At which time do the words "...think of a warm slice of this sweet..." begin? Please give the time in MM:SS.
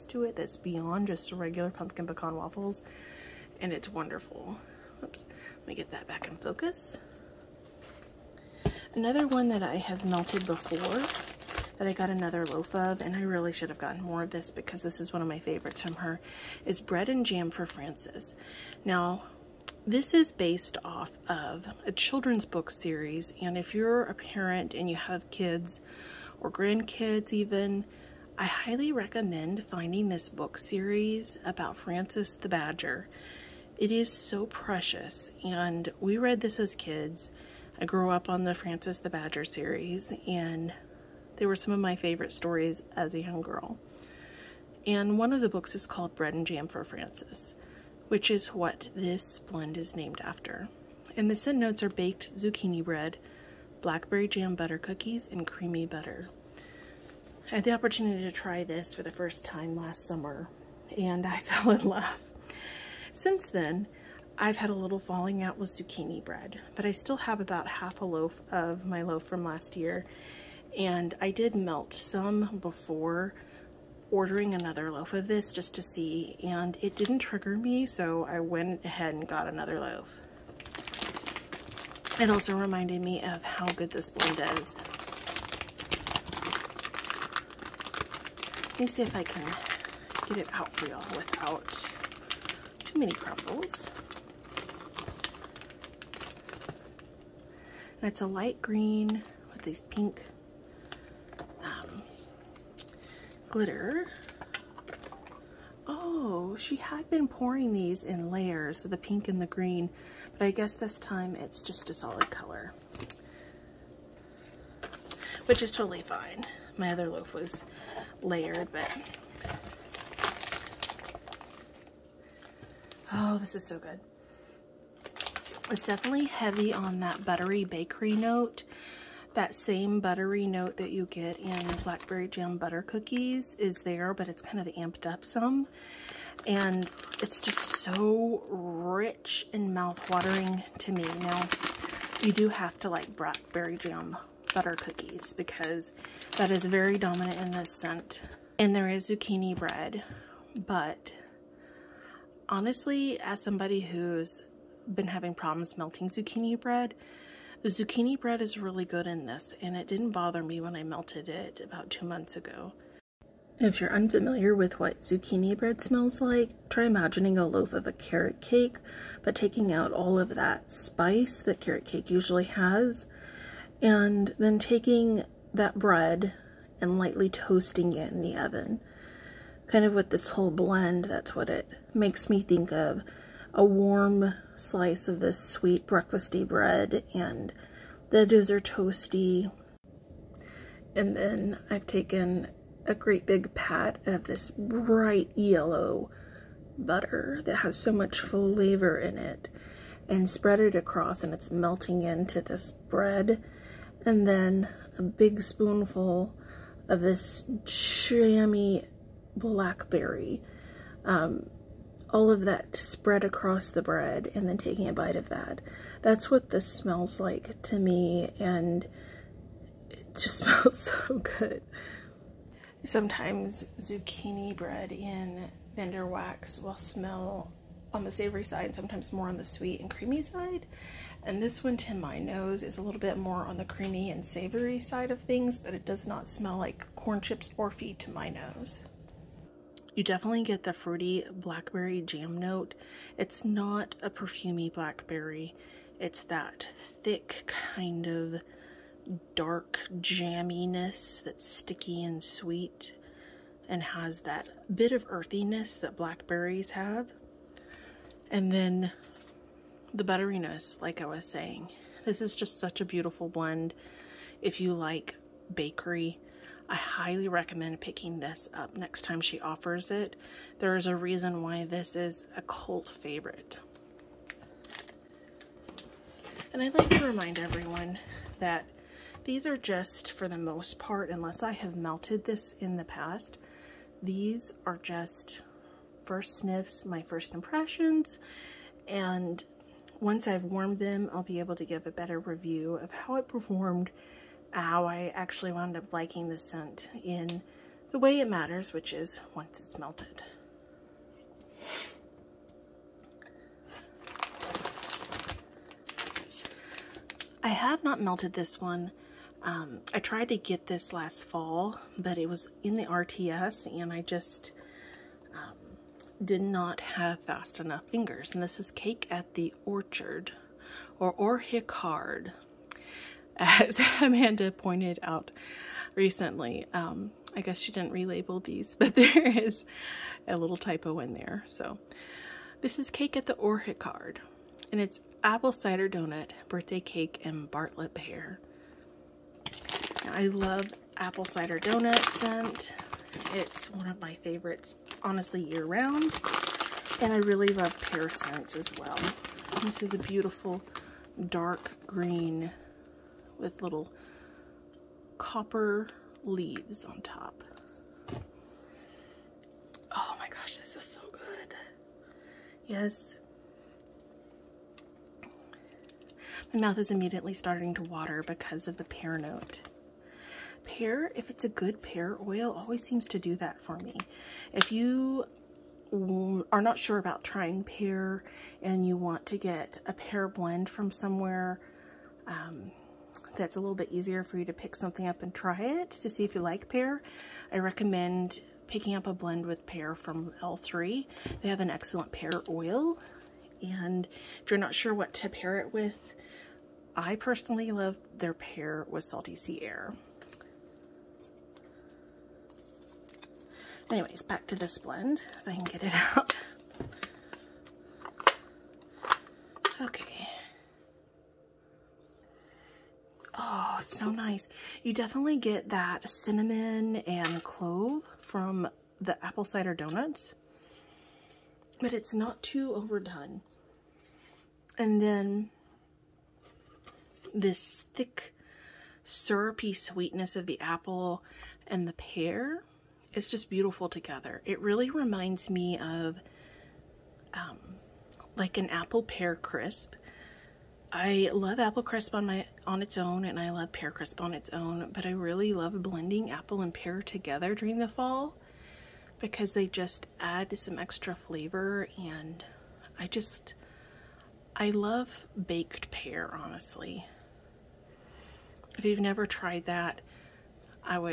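03:02.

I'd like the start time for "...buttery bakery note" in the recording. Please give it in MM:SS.
02:07.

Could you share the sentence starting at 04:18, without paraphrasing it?
And then the butteriness, like I was saying.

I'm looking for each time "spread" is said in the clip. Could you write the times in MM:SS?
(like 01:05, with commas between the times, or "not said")
03:20, 03:32.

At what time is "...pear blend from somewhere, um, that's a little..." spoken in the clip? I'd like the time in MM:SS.
06:19.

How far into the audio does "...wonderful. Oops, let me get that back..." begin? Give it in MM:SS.
00:03.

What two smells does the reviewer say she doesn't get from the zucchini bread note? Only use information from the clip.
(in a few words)
Corn chips or feed.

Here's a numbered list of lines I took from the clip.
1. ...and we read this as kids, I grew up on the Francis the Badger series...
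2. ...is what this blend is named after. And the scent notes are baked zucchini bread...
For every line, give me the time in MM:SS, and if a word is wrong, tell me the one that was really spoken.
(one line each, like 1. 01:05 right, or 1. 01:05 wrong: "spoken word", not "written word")
1. 00:35 right
2. 00:48 right.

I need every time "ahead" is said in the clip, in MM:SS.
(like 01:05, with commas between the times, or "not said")
01:18.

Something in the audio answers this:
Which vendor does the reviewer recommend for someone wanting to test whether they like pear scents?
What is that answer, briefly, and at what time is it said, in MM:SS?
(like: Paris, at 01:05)
L3, at 06:30.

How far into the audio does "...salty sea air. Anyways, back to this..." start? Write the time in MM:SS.
06:39.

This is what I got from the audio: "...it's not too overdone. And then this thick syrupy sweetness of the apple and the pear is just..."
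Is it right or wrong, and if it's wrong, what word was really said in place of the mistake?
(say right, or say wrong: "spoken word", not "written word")
right.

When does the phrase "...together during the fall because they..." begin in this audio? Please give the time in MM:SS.
07:26.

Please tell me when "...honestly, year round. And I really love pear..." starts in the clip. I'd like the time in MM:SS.
05:45.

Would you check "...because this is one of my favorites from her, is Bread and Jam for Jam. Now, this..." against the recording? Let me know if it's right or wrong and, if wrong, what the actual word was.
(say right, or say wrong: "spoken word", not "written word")
wrong: "Francis", not "Jam".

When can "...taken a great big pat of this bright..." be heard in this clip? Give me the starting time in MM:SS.
03:11.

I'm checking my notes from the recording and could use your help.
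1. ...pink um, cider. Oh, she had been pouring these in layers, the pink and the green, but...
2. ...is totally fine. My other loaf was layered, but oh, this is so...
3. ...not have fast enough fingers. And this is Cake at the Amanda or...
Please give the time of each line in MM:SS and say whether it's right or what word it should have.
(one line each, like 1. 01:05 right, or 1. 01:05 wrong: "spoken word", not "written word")
1. 01:39 wrong: "glitter", not "cider"
2. 01:55 right
3. 05:16 wrong: "Orchard", not "Amanda".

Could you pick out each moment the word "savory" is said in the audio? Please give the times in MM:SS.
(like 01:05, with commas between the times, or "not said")
03:48, 03:54.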